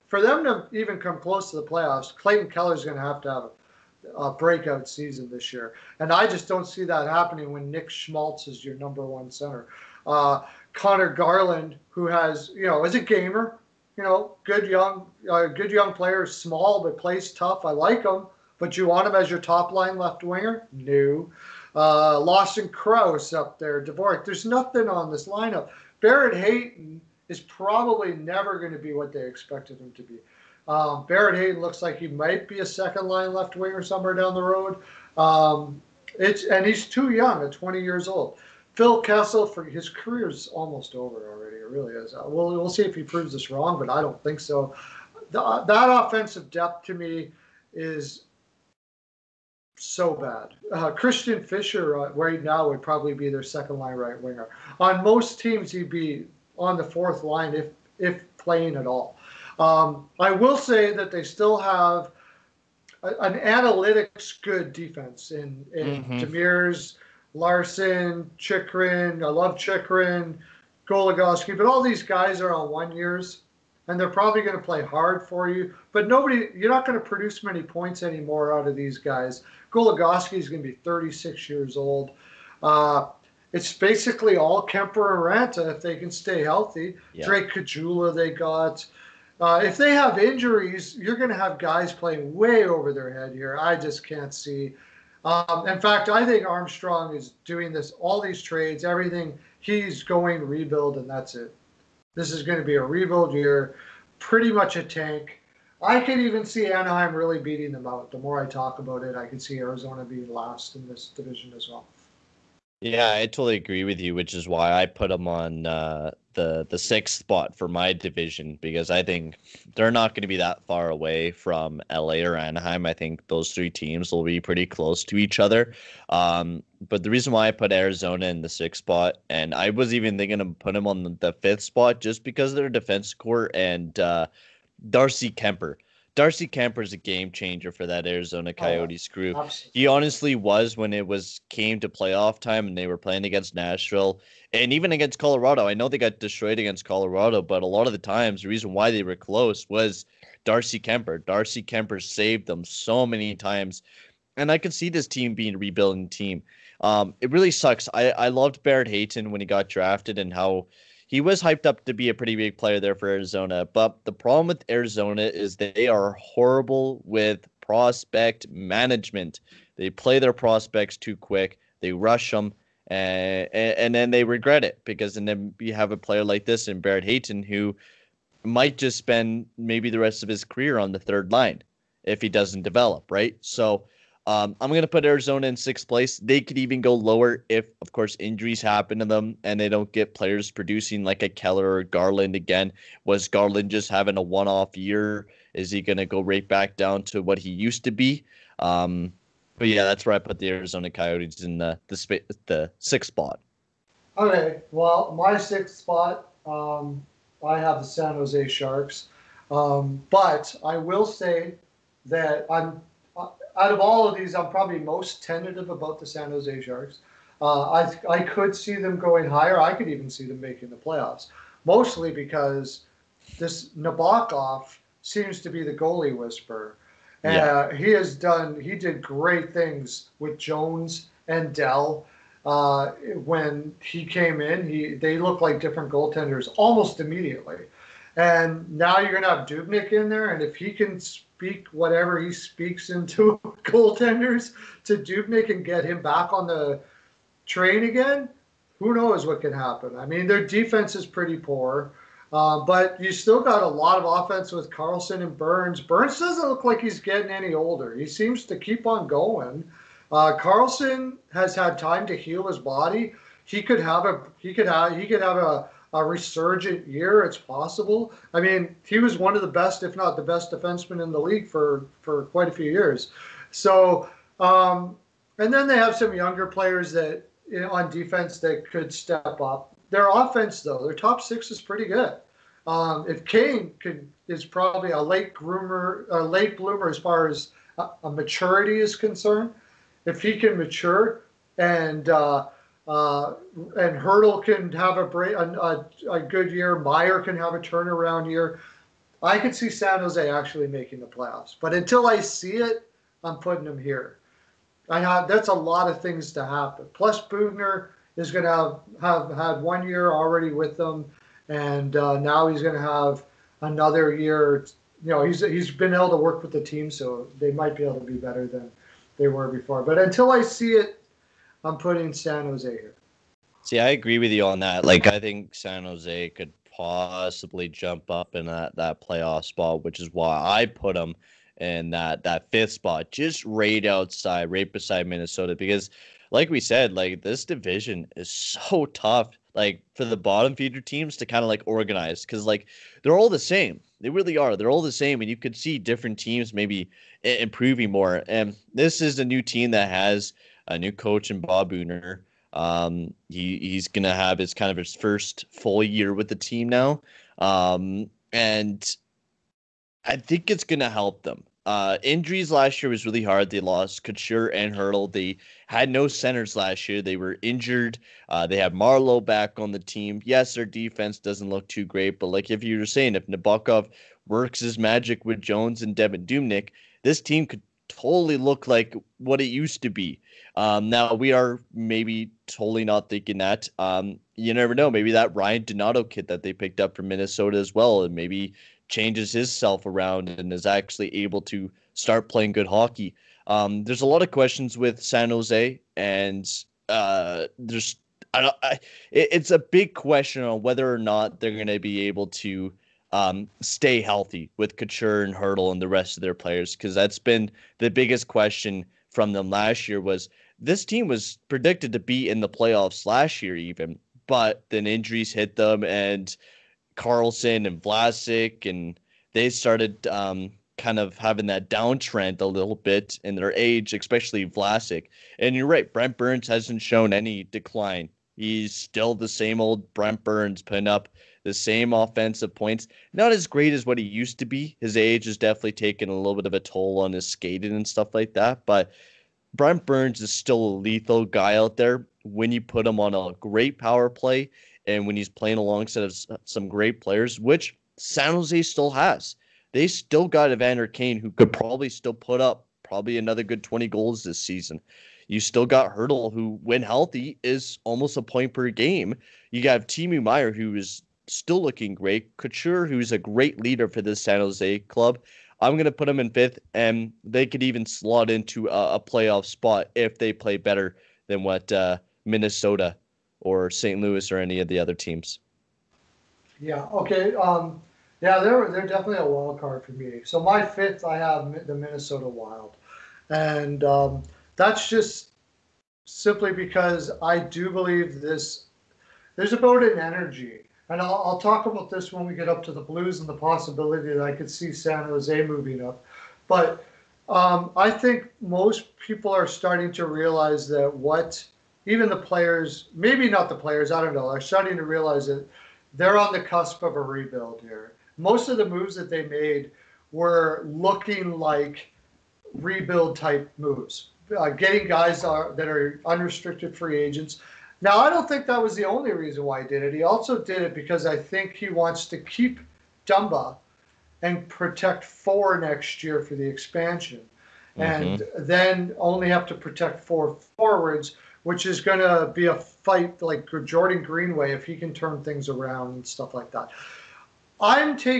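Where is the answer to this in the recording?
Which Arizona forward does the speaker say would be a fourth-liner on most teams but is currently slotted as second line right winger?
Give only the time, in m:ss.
0:50.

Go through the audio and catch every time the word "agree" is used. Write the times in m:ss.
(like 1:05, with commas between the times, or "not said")
1:53, 5:23.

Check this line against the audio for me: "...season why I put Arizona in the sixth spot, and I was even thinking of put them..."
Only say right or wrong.
wrong.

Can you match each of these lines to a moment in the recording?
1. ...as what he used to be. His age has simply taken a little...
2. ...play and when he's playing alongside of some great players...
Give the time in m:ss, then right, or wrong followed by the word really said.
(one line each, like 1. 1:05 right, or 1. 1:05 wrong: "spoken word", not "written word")
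1. 7:13 wrong: "definitely", not "simply"
2. 7:24 right.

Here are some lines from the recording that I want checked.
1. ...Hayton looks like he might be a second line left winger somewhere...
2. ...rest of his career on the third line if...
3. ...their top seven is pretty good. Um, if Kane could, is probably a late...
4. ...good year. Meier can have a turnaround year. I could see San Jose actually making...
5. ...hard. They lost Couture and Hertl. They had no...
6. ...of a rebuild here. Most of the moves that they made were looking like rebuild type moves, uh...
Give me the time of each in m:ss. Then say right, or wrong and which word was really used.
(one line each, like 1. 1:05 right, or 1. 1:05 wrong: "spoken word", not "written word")
1. 0:31 right
2. 2:59 right
3. 4:40 wrong: "six", not "seven"
4. 4:56 right
5. 6:03 right
6. 8:26 right.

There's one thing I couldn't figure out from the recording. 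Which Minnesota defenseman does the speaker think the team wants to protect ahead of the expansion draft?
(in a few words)
Dumba.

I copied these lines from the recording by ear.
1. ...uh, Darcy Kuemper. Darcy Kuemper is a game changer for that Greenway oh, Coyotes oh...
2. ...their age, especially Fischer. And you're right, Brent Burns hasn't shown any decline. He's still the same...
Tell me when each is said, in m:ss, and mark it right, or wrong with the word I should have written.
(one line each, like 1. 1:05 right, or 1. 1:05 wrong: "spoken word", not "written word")
1. 2:13 wrong: "Arizona", not "Greenway"
2. 7:03 wrong: "Vlasic", not "Fischer".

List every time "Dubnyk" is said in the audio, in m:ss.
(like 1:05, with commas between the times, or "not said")
3:59, 4:04, 6:16.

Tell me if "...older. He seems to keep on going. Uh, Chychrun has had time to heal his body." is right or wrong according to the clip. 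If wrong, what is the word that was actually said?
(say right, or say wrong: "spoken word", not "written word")
wrong: "Karlsson", not "Chychrun".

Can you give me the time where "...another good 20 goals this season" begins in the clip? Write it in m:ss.
7:33.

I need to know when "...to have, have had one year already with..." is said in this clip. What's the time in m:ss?
5:08.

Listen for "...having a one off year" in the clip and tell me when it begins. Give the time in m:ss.
3:13.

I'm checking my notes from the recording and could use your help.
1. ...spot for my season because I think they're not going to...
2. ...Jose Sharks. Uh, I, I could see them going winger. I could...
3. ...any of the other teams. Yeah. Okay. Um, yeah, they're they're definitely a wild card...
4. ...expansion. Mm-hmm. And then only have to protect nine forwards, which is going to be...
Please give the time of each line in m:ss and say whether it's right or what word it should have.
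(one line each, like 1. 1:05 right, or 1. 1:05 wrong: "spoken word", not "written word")
1. 1:57 wrong: "division", not "season"
2. 3:36 wrong: "higher", not "winger"
3. 7:54 right
4. 8:46 wrong: "four", not "nine".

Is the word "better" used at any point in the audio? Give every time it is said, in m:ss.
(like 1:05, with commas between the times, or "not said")
5:18, 7:50.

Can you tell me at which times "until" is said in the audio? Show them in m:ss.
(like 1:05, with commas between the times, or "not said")
5:01, 5:19.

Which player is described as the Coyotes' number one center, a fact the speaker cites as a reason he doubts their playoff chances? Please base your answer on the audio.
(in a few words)
Nick Schmaltz.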